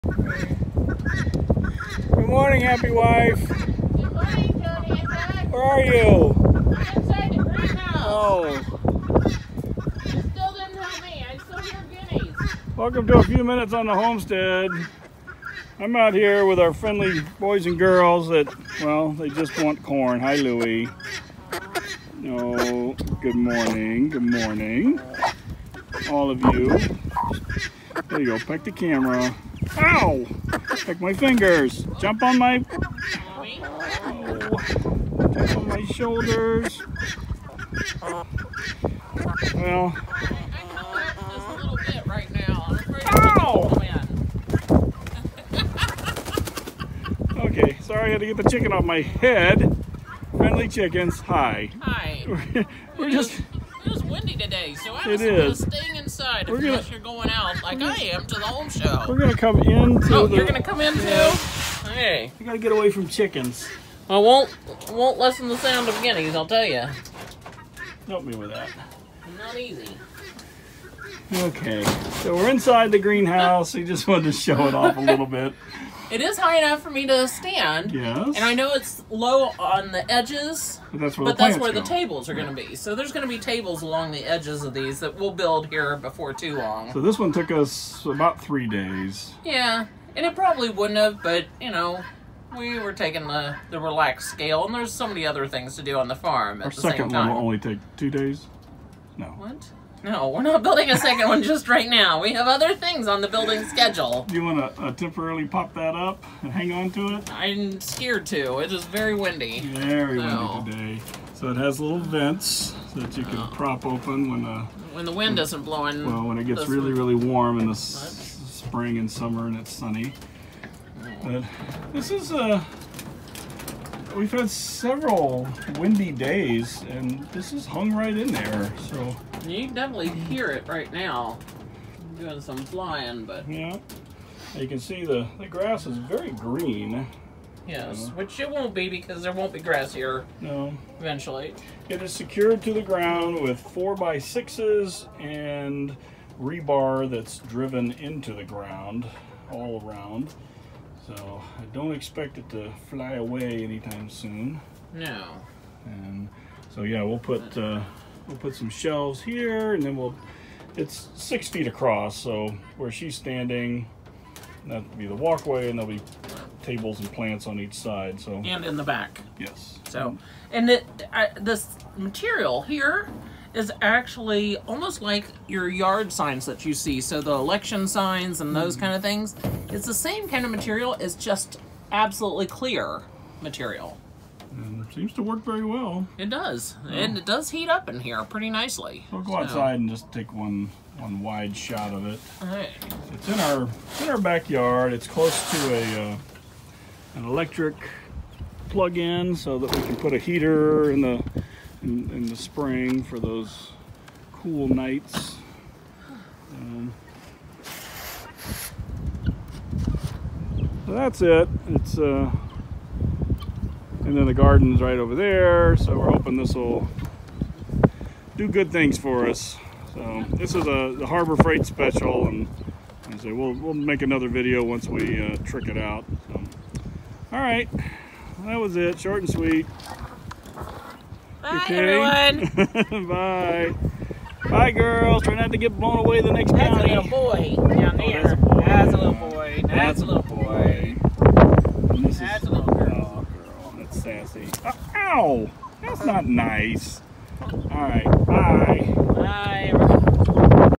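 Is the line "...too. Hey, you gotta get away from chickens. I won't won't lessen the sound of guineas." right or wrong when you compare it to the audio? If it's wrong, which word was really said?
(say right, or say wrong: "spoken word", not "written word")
right.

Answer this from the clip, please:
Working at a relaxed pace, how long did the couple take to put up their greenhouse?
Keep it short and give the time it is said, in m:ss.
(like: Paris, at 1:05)
3 days, at 1:28.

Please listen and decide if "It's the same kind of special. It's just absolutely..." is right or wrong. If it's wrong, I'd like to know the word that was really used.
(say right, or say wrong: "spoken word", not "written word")
wrong: "material", not "special".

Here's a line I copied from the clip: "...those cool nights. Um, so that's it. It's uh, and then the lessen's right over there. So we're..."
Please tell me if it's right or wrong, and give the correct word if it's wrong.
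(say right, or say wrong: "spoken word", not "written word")
wrong: "garden", not "lessen".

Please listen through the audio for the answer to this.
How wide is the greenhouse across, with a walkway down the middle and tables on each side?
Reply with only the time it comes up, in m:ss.
2:41.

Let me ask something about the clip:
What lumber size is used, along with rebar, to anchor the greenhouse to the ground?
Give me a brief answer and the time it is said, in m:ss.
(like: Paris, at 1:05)
4 by 6, at 2:23.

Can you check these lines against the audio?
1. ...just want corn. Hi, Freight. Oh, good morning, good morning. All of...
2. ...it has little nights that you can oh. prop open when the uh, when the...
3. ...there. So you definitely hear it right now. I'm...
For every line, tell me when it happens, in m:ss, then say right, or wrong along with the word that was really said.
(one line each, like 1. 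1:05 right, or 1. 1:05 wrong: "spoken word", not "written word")
1. 0:19 wrong: "Louie", not "Freight"
2. 1:51 wrong: "vents", not "nights"
3. 2:08 right.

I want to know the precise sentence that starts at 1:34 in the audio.
And there's so many other things to do on the farm at Our the same time.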